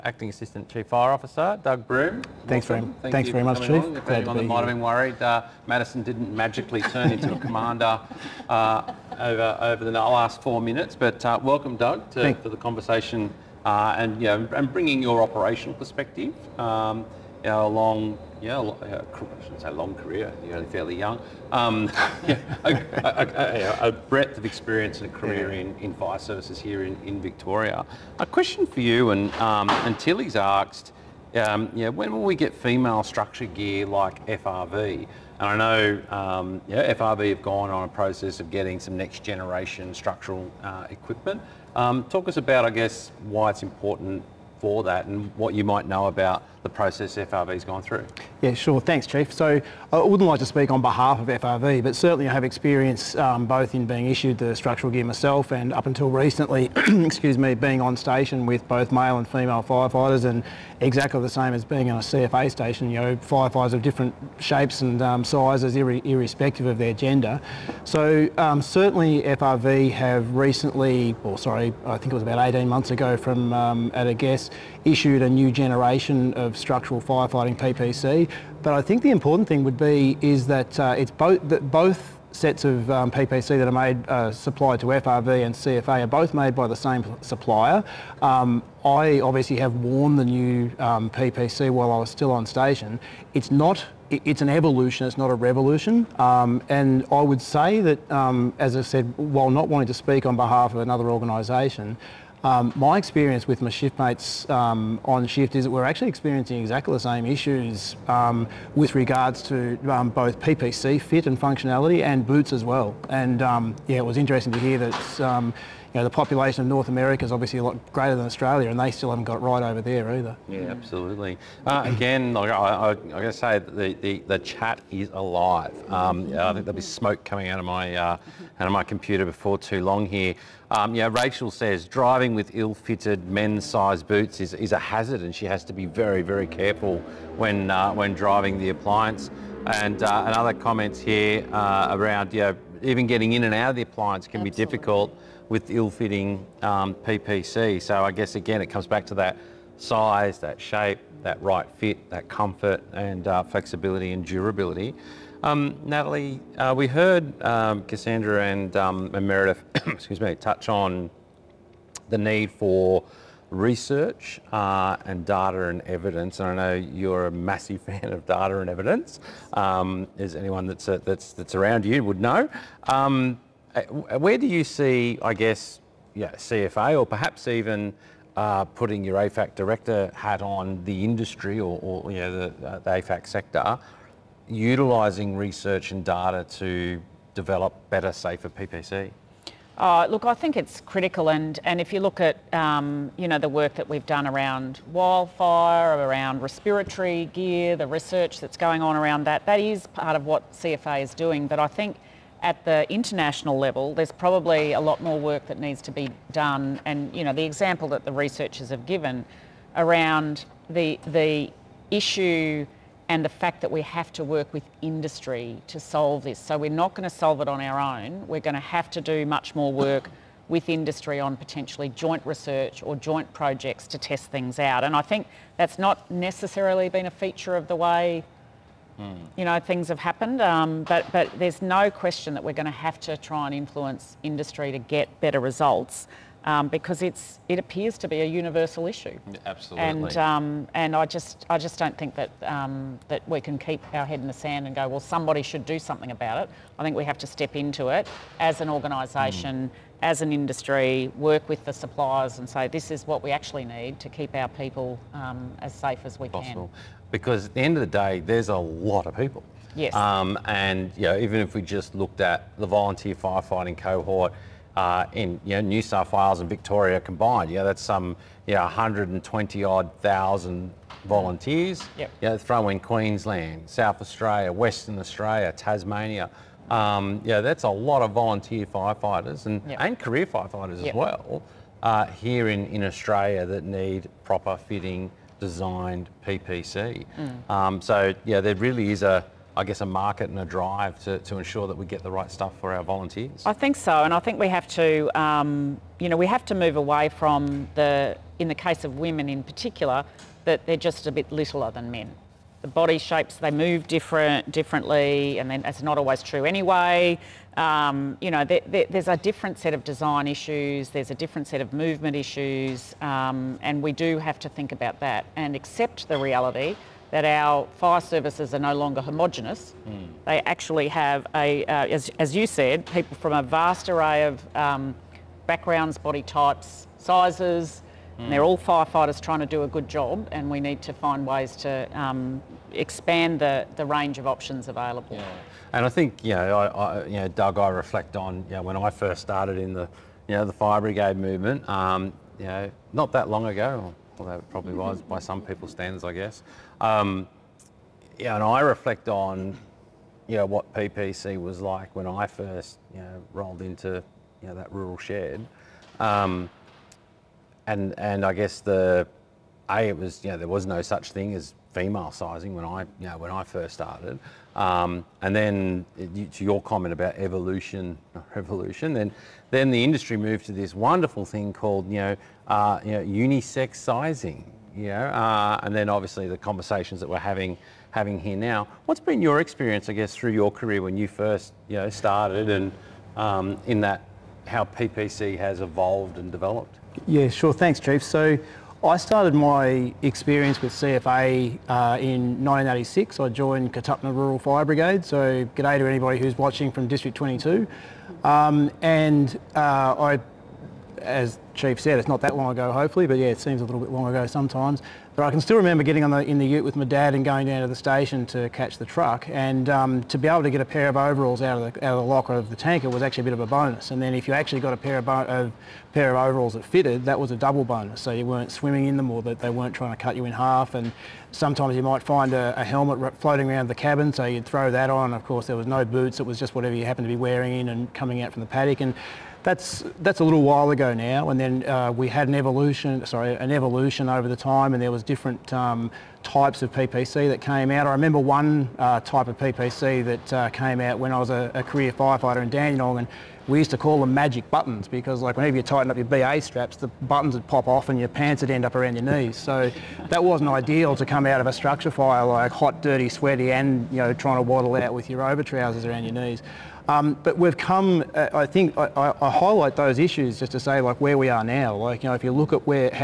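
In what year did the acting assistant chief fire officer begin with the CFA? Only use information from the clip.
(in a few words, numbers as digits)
1986.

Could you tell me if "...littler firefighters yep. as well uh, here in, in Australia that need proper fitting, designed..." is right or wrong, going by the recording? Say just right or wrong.
wrong.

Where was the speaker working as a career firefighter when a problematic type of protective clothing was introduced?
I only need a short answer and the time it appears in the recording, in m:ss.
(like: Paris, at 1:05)
Dandenong, at 7:22.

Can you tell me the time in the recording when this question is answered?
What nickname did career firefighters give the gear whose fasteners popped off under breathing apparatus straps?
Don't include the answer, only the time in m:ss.
7:24.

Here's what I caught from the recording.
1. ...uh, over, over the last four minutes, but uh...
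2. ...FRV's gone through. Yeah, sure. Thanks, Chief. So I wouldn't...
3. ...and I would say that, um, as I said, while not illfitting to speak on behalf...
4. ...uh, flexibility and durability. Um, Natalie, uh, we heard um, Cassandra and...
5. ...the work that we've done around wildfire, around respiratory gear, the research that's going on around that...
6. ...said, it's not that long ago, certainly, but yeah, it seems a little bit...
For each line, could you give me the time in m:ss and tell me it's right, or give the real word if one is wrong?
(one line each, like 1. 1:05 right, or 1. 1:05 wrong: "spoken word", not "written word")
1. 0:08 right
2. 0:47 right
3. 1:36 wrong: "wanting", not "illfitting"
4. 2:33 right
5. 3:13 right
6. 6:41 wrong: "hopefully", not "certainly".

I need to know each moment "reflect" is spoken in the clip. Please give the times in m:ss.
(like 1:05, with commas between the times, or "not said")
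5:37, 5:48.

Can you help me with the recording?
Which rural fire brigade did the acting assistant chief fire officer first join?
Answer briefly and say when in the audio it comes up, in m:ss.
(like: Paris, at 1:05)
Katupna Rural Fire Brigade, at 6:33.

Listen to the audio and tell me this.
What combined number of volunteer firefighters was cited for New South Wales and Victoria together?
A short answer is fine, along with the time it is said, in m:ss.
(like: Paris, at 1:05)
120 odd thousand, at 4:28.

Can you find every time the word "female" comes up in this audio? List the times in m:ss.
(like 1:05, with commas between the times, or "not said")
0:32, 0:59, 6:01.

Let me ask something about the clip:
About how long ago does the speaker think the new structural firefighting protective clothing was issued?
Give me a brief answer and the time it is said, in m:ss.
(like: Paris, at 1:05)
18 months, at 1:12.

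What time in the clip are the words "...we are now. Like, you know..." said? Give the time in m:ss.
7:41.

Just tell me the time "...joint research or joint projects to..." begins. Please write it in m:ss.
3:41.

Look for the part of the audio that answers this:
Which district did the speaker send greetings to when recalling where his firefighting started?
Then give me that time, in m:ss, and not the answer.
6:36.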